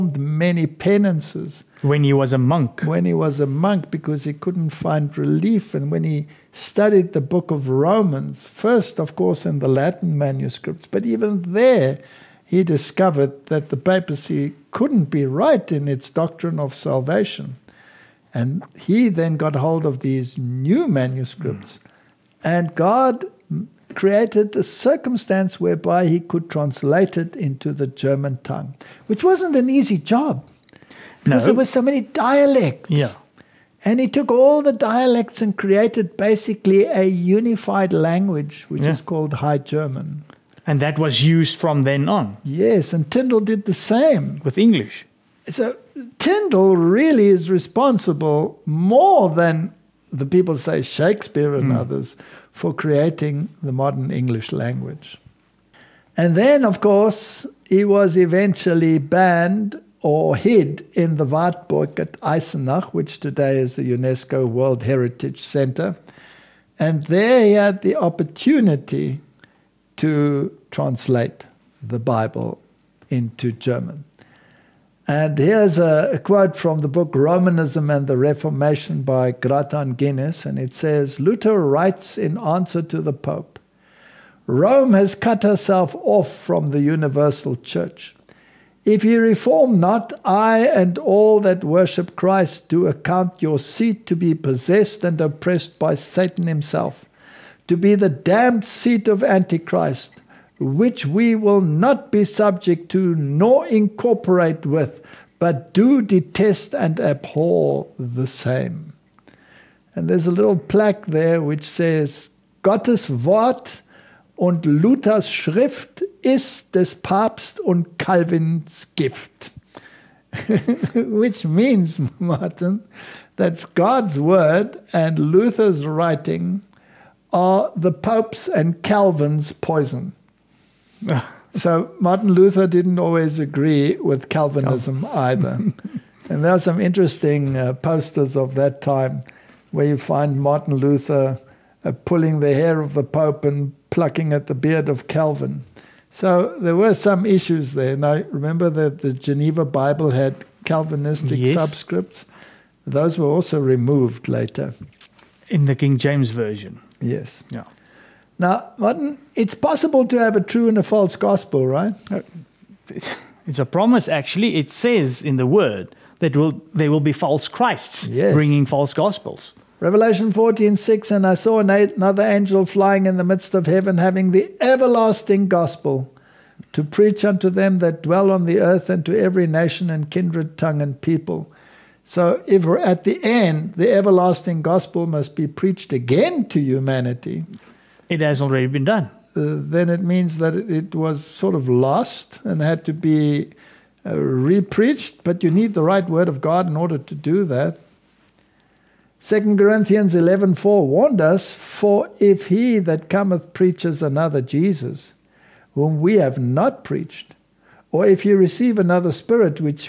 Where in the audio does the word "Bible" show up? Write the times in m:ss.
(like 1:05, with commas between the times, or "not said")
1:11, 2:29.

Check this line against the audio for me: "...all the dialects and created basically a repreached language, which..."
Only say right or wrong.
wrong.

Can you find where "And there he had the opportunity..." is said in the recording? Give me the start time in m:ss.
1:06.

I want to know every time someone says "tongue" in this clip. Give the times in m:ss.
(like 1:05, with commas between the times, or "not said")
0:28, 3:00.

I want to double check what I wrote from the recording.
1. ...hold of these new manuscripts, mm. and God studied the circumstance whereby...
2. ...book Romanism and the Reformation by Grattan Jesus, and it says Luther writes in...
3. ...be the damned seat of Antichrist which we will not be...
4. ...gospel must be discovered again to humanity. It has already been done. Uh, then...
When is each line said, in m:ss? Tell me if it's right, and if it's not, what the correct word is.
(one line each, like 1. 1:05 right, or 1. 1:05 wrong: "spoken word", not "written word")
1. 0:19 wrong: "created", not "studied"
2. 1:16 wrong: "Guinness", not "Jesus"
3. 1:37 right
4. 3:04 wrong: "preached", not "discovered".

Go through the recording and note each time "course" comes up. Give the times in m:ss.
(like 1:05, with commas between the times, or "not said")
0:09, 0:56.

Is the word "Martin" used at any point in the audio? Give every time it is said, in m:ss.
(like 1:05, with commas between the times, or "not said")
2:02, 2:11, 2:20, 2:38.